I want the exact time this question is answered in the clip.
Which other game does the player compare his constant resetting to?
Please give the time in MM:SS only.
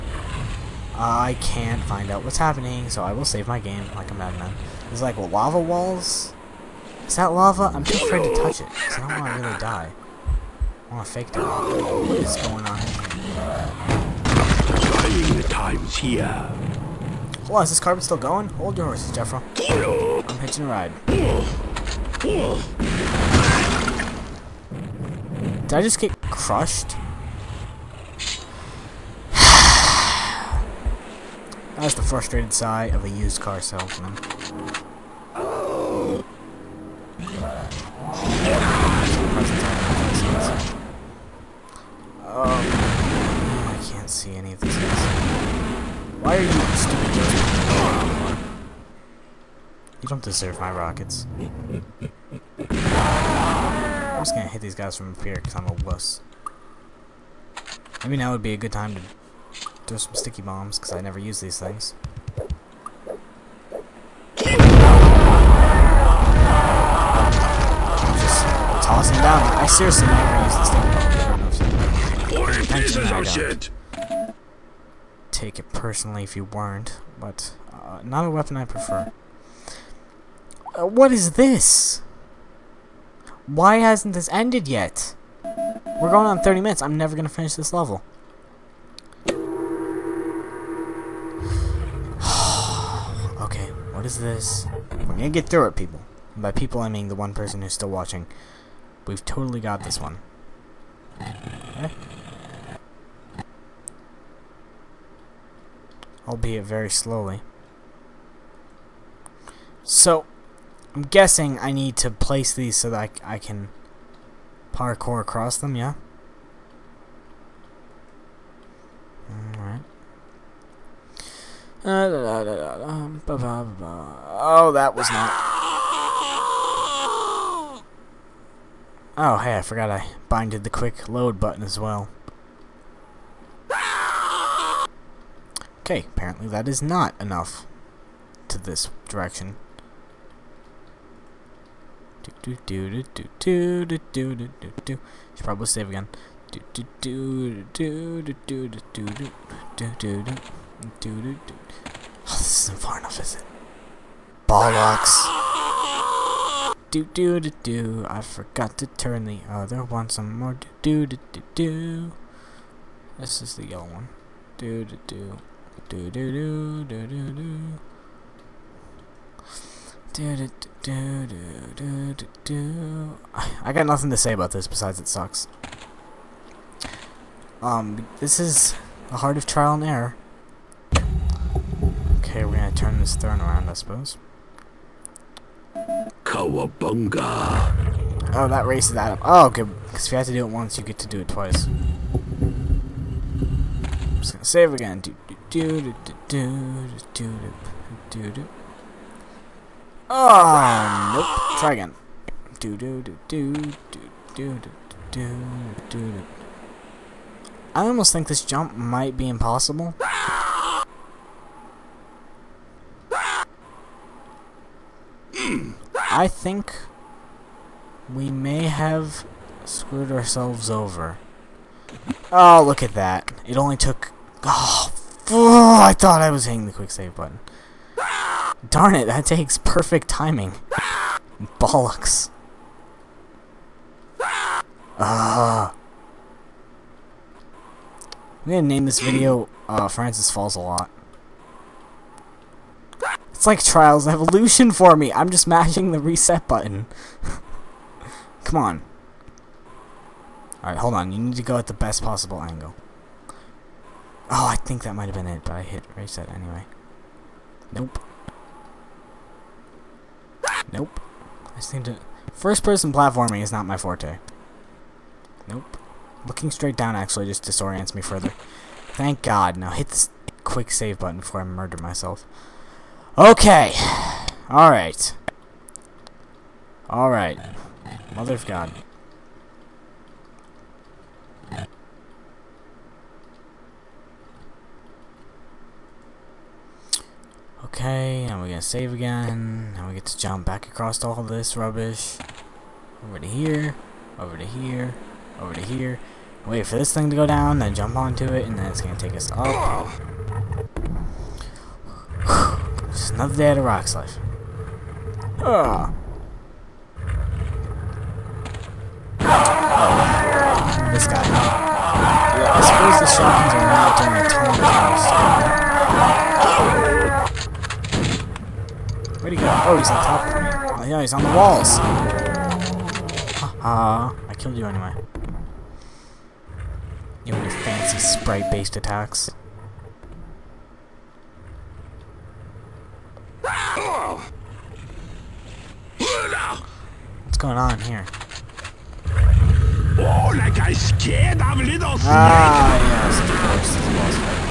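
04:03.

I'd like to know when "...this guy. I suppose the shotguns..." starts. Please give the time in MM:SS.
05:10.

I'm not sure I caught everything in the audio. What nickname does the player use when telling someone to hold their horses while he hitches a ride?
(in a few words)
Jeffro.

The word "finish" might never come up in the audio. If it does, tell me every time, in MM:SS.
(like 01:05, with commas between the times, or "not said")
01:27.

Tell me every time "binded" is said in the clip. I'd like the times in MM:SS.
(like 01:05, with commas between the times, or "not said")
02:10.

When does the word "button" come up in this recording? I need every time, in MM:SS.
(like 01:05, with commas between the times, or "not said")
02:11, 03:47, 04:06, 04:30.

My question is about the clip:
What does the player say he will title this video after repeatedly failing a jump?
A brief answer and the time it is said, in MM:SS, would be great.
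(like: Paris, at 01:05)
Francis Falls a lot, at 03:59.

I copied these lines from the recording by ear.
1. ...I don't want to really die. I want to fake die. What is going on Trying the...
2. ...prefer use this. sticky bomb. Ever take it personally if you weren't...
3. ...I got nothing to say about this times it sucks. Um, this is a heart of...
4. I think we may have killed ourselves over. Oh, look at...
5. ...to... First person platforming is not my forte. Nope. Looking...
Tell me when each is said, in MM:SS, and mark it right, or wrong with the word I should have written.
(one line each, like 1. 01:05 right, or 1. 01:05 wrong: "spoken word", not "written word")
1. 00:08 right
2. 01:10 wrong: "never", not "prefer"
3. 02:53 wrong: "besides", not "times"
4. 03:36 wrong: "screwed", not "killed"
5. 04:21 right.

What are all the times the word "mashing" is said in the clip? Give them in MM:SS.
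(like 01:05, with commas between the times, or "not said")
04:05.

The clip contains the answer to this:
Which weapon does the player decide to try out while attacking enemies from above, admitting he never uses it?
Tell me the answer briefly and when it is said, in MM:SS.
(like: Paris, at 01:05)
Sticky bombs, at 01:00.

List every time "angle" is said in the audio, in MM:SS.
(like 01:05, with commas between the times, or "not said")
04:12.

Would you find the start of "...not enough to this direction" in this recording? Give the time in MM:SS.
02:16.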